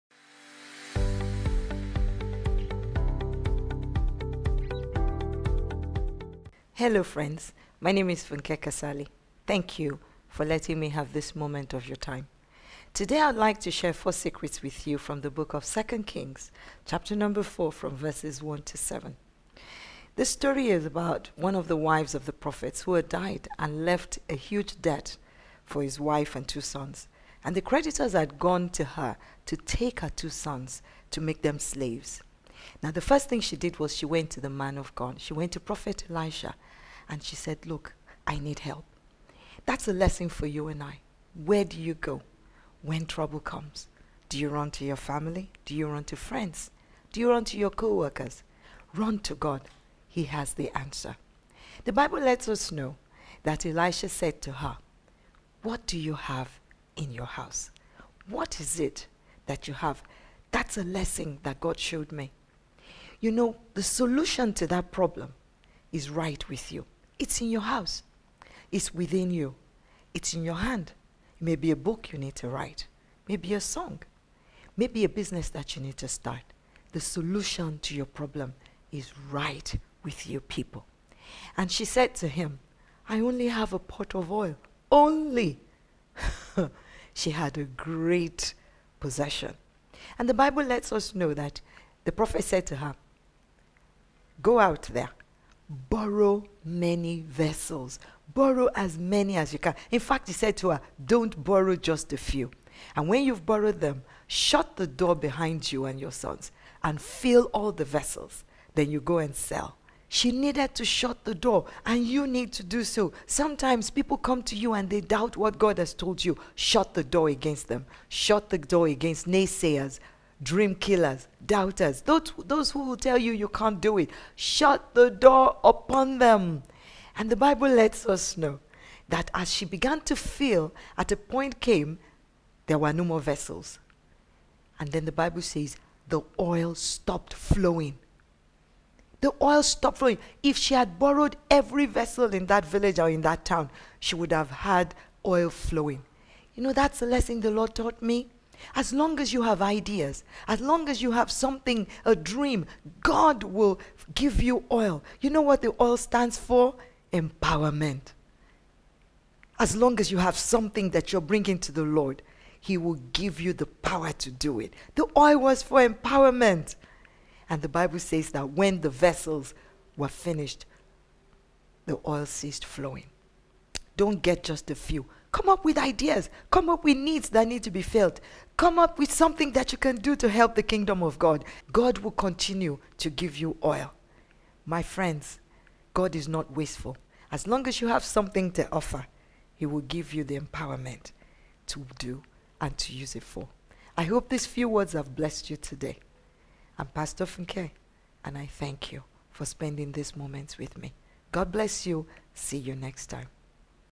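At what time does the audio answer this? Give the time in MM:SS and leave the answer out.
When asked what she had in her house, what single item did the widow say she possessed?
01:23.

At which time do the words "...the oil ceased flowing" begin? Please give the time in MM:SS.
02:51.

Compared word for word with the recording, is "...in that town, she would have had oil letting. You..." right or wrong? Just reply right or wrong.
wrong.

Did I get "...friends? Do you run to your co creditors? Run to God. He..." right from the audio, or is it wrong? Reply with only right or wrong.
wrong.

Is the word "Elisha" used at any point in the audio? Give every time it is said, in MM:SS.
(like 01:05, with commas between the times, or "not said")
00:36, 00:53.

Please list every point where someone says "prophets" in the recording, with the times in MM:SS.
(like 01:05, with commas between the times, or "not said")
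00:22, 00:35, 01:32.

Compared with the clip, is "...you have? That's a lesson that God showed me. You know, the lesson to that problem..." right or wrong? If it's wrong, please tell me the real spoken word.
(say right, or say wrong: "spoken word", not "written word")
wrong: "solution", not "lesson".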